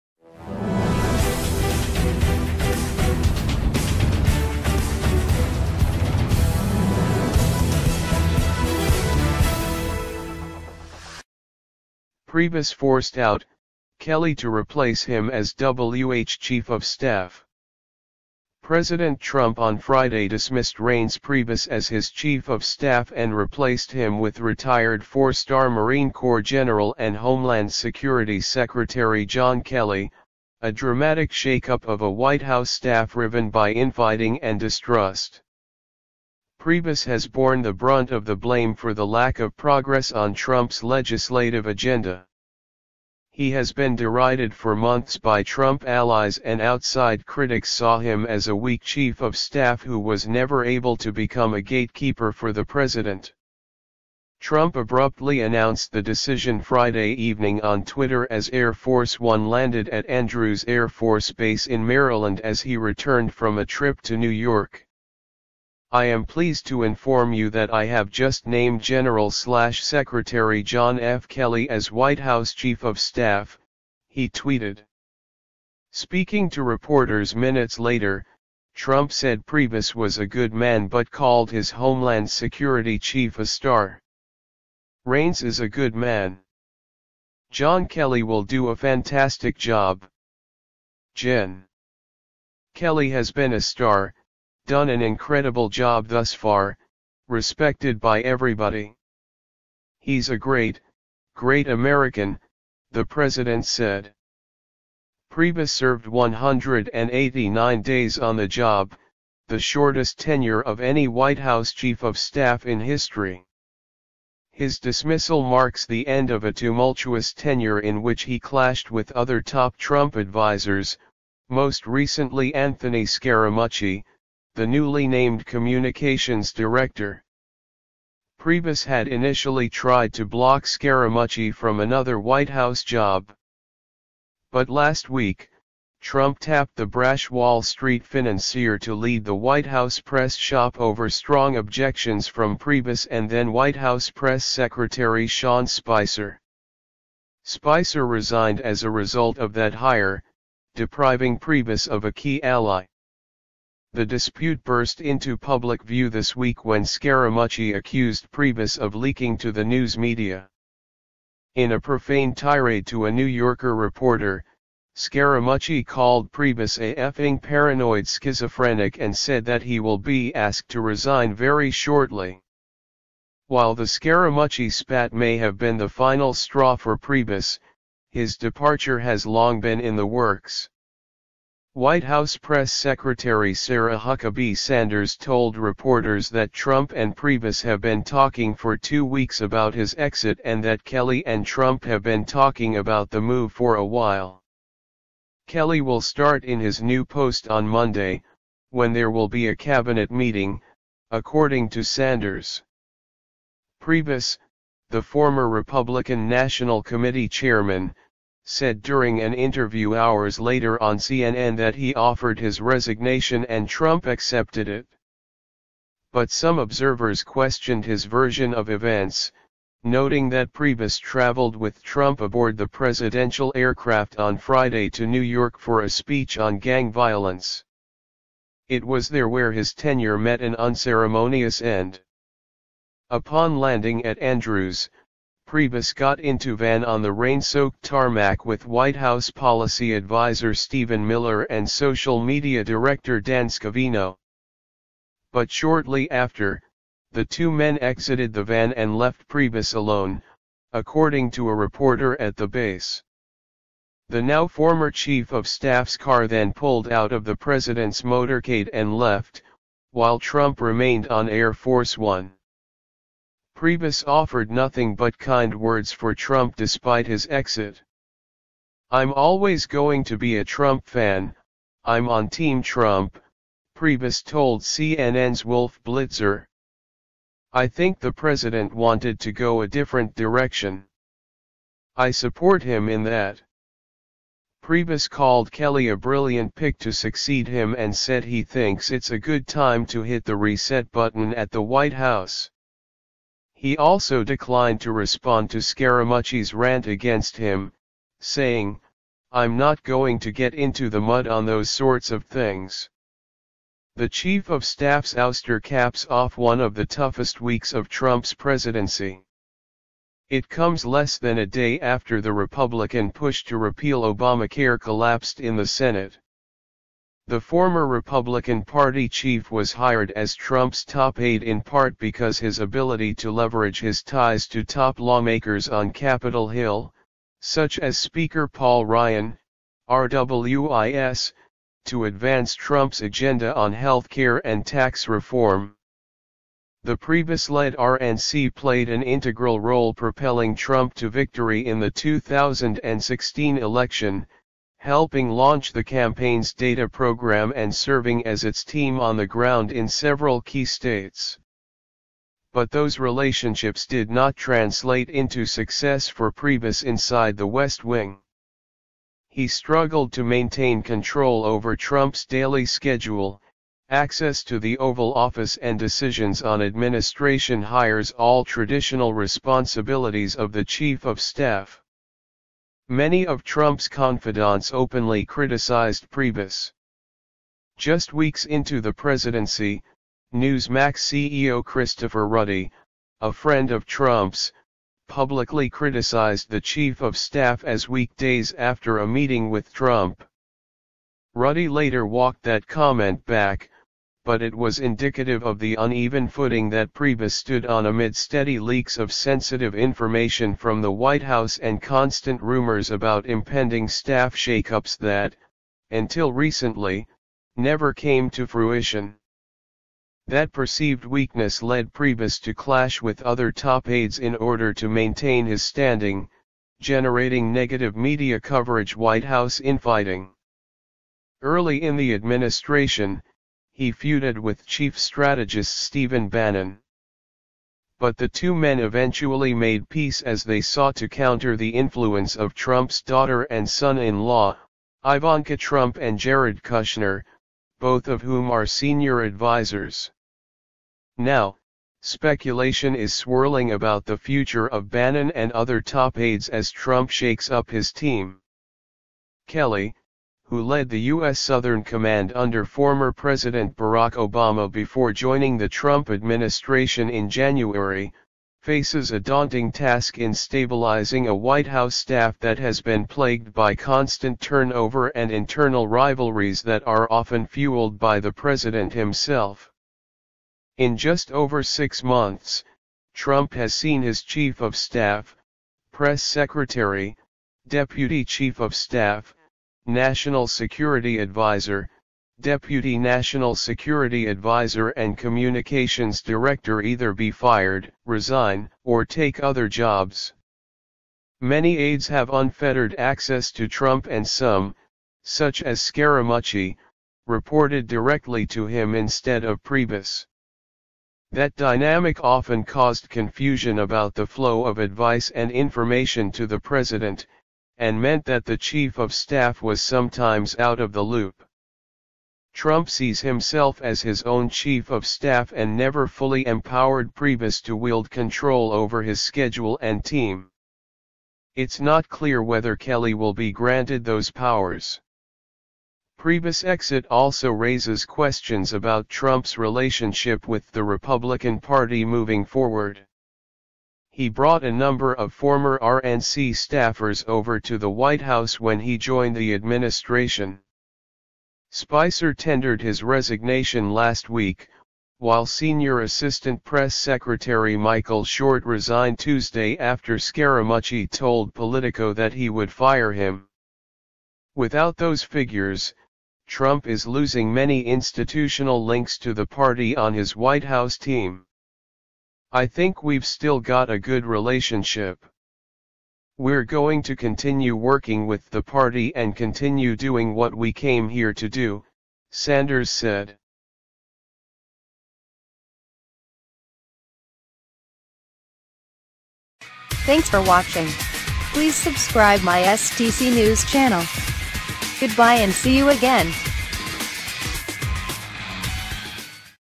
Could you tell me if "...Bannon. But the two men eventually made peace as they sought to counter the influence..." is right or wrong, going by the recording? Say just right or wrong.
right.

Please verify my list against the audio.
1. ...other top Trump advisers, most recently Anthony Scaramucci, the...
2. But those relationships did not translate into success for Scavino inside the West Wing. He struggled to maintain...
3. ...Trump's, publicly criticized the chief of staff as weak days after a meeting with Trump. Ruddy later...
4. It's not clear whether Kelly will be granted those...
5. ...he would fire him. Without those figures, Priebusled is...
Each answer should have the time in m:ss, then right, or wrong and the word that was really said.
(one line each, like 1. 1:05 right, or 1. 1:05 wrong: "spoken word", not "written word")
1. 1:59 right
2. 5:52 wrong: "Priebus", not "Scavino"
3. 6:23 right
4. 8:41 right
5. 9:12 wrong: "Trump", not "Priebusled".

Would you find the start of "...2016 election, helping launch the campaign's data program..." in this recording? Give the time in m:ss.
5:41.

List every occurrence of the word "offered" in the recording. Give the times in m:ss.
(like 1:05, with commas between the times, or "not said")
3:31, 4:24.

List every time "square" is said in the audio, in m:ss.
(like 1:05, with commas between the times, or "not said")
not said.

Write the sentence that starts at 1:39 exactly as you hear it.
He's a great, great American, the president said.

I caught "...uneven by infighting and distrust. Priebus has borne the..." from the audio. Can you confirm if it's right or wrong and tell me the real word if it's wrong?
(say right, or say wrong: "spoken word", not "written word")
wrong: "riven", not "uneven".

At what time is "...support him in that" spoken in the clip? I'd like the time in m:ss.
4:42.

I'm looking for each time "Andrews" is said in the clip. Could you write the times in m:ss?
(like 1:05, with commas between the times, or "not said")
1:00, 3:54.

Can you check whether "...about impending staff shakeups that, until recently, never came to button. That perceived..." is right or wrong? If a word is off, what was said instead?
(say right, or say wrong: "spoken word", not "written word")
wrong: "fruition", not "button".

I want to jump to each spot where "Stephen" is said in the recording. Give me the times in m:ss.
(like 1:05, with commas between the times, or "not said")
4:00, 7:05.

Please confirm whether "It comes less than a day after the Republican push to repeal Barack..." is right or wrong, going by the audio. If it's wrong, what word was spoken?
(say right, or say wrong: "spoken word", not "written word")
wrong: "Obamacare", not "Barack".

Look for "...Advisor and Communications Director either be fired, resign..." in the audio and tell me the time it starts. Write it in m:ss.
8:04.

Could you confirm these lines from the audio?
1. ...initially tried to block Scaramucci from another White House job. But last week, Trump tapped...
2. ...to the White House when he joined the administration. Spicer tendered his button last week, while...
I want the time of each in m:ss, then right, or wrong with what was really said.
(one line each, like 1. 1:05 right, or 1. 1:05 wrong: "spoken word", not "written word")
1. 2:09 right
2. 8:57 wrong: "resignation", not "button".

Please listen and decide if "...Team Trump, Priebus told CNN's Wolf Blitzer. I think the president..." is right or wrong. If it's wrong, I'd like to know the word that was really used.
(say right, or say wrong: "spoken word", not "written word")
right.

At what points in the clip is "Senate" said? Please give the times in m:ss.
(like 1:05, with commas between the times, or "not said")
5:15.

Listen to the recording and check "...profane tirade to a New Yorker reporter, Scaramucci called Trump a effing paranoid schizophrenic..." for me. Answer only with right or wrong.
wrong.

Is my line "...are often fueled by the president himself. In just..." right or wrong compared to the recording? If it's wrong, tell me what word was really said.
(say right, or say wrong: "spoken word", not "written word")
right.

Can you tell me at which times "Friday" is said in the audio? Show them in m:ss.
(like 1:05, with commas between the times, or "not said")
0:19, 0:56, 3:44.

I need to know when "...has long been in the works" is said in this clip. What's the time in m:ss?
2:58.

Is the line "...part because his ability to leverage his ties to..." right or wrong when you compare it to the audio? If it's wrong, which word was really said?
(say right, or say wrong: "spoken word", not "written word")
right.